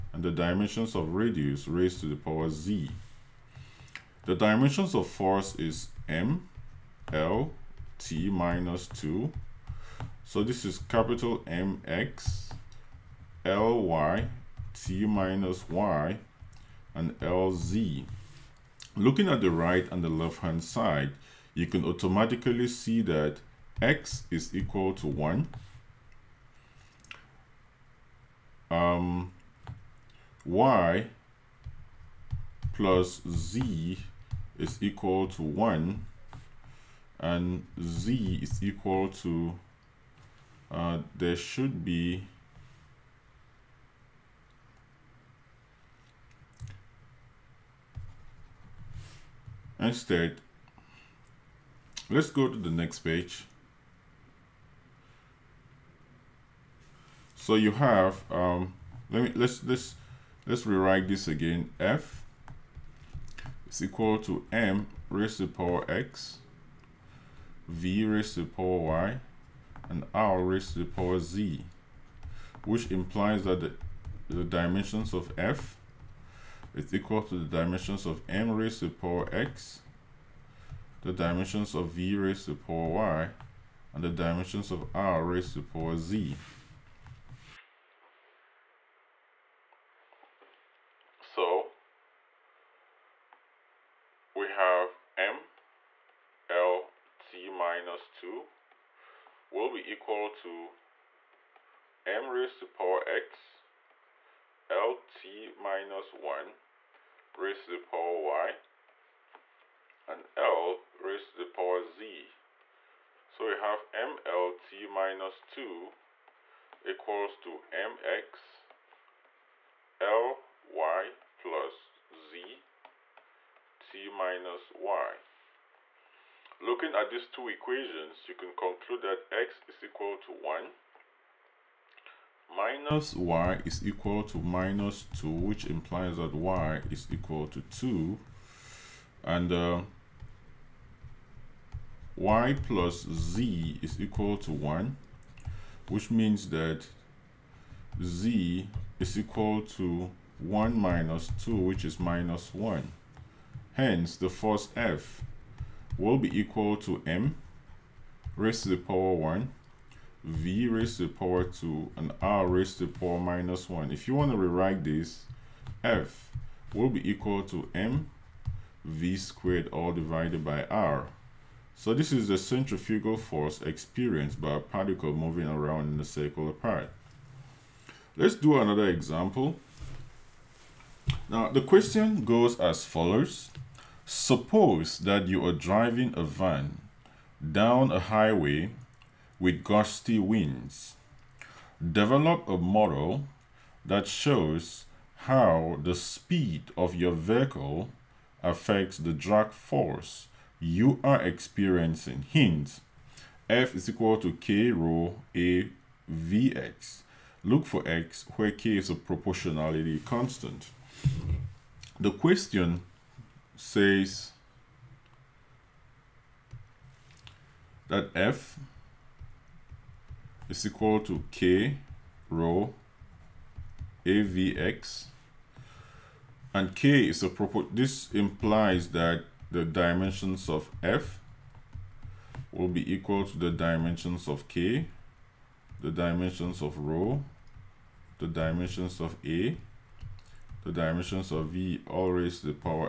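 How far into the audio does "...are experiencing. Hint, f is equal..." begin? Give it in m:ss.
3:21.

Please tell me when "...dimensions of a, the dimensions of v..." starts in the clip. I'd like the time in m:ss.
3:58.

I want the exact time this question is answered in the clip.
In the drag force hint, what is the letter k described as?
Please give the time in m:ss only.
3:28.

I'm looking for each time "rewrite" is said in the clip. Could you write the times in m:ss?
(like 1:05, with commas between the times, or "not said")
1:00, 2:44.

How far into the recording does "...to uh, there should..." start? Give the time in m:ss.
0:39.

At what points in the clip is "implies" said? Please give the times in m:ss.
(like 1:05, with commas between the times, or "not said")
1:12, 2:15, 3:48.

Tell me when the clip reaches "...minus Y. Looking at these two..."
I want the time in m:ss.
2:04.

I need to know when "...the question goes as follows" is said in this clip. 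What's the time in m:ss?
3:01.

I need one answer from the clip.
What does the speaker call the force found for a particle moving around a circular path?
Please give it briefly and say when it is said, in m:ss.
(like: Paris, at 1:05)
centrifugal force, at 2:52.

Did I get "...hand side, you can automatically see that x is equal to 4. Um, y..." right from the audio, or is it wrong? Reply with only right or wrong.
wrong.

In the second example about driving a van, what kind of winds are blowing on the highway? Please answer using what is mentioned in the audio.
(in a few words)
gusty winds.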